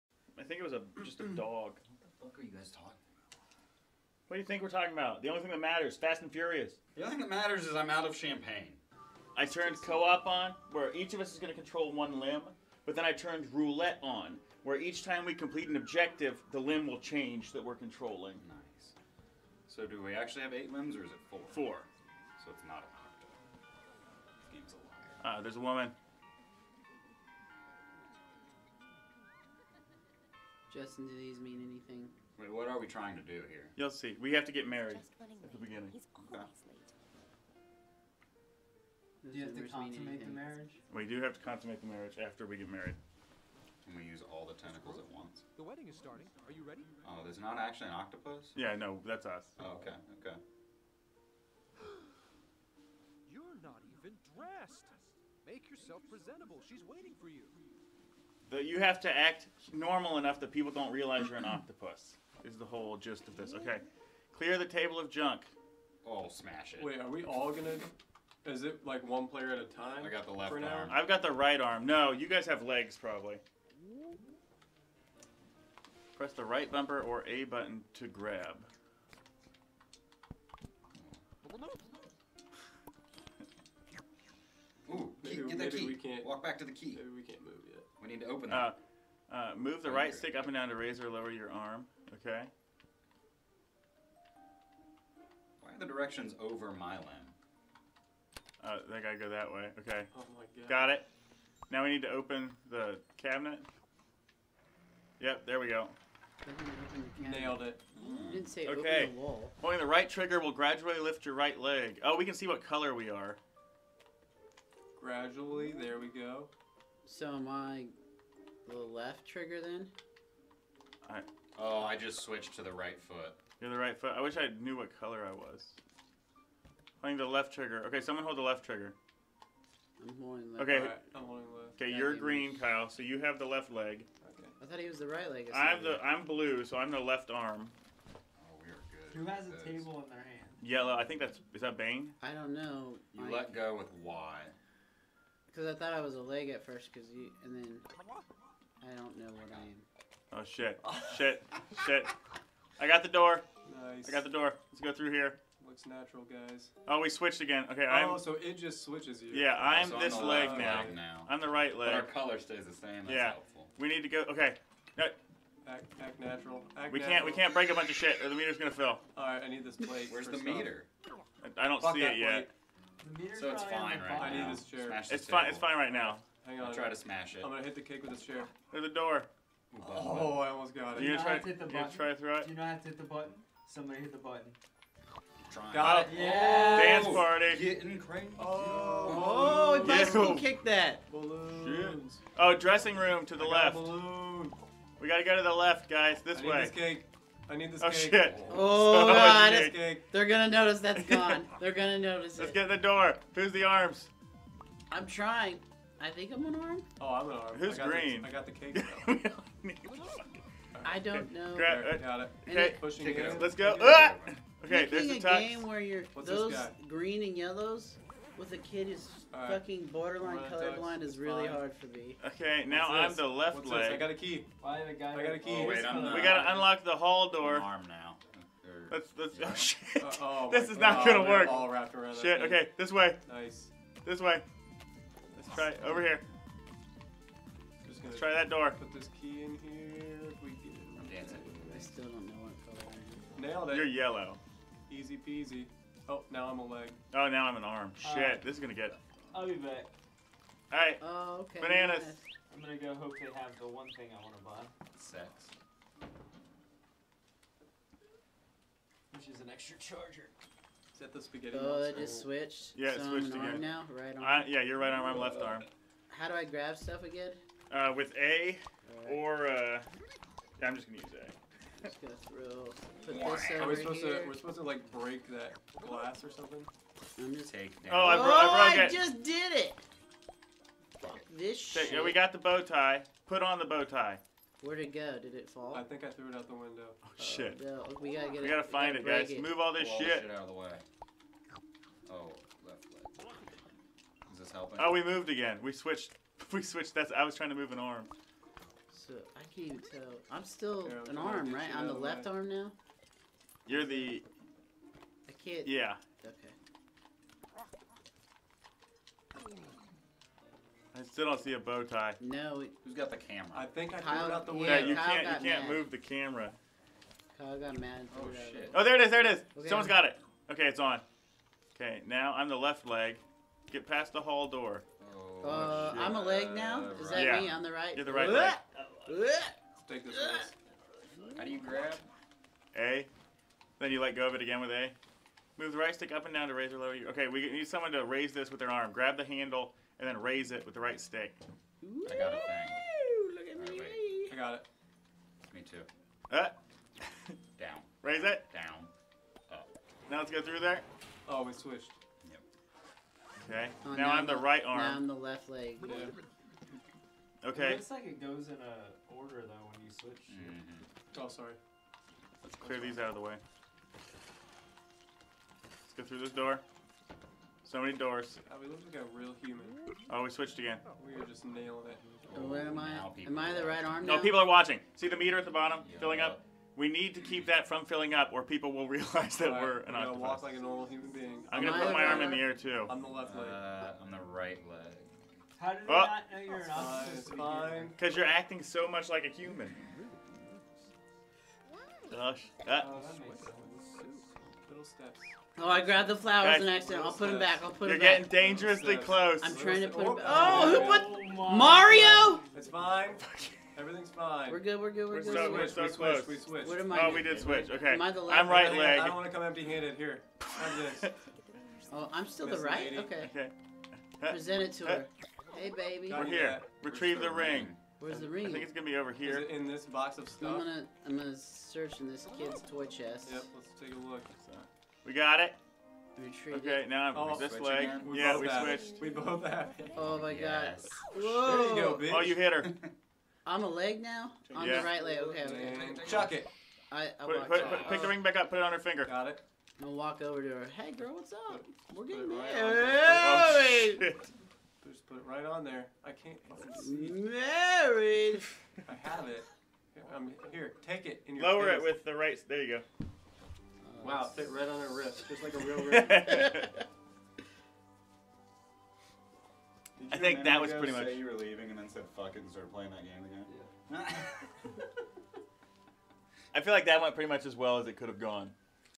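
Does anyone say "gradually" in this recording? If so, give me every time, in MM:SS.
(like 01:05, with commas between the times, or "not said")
01:50, 01:55.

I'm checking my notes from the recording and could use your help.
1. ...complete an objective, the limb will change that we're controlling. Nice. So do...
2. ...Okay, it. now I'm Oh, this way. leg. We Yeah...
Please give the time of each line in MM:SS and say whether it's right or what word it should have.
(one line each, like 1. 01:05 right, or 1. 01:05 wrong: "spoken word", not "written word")
1. 00:15 right
2. 07:06 right.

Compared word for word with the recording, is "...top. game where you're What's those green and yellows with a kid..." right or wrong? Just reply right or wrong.
right.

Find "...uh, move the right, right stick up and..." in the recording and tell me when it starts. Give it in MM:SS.
01:29.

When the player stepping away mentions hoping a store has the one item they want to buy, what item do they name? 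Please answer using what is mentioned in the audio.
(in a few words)
An extra charger.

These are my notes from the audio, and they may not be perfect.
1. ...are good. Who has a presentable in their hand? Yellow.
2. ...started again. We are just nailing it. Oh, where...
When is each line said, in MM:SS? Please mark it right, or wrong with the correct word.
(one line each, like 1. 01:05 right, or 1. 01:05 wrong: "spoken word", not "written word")
1. 02:18 wrong: "table", not "presentable"
2. 06:10 wrong: "switched", not "started".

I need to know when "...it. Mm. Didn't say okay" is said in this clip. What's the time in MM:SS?
01:47.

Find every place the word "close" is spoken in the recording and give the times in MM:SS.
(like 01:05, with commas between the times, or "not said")
06:38, 06:45.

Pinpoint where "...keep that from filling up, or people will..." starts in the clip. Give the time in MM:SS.
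06:17.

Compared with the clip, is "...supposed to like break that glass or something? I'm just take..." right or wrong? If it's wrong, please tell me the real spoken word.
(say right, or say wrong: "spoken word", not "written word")
right.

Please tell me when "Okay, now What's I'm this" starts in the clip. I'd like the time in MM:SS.
03:42.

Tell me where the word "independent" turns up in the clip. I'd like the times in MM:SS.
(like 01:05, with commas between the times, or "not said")
not said.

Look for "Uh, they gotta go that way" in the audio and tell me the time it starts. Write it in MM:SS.
01:38.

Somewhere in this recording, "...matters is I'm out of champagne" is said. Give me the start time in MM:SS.
00:07.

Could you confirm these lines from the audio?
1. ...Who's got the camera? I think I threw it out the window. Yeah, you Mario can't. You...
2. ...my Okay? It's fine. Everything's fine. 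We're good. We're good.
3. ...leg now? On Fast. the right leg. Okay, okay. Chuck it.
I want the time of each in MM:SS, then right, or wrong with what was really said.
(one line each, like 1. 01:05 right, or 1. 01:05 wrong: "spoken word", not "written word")
1. 05:12 wrong: "Kyle", not "Mario"
2. 06:41 wrong: "Mario", not "Okay"
3. 07:13 wrong: "Yeah", not "Fast".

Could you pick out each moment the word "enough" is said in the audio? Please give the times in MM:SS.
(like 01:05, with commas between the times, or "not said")
01:00.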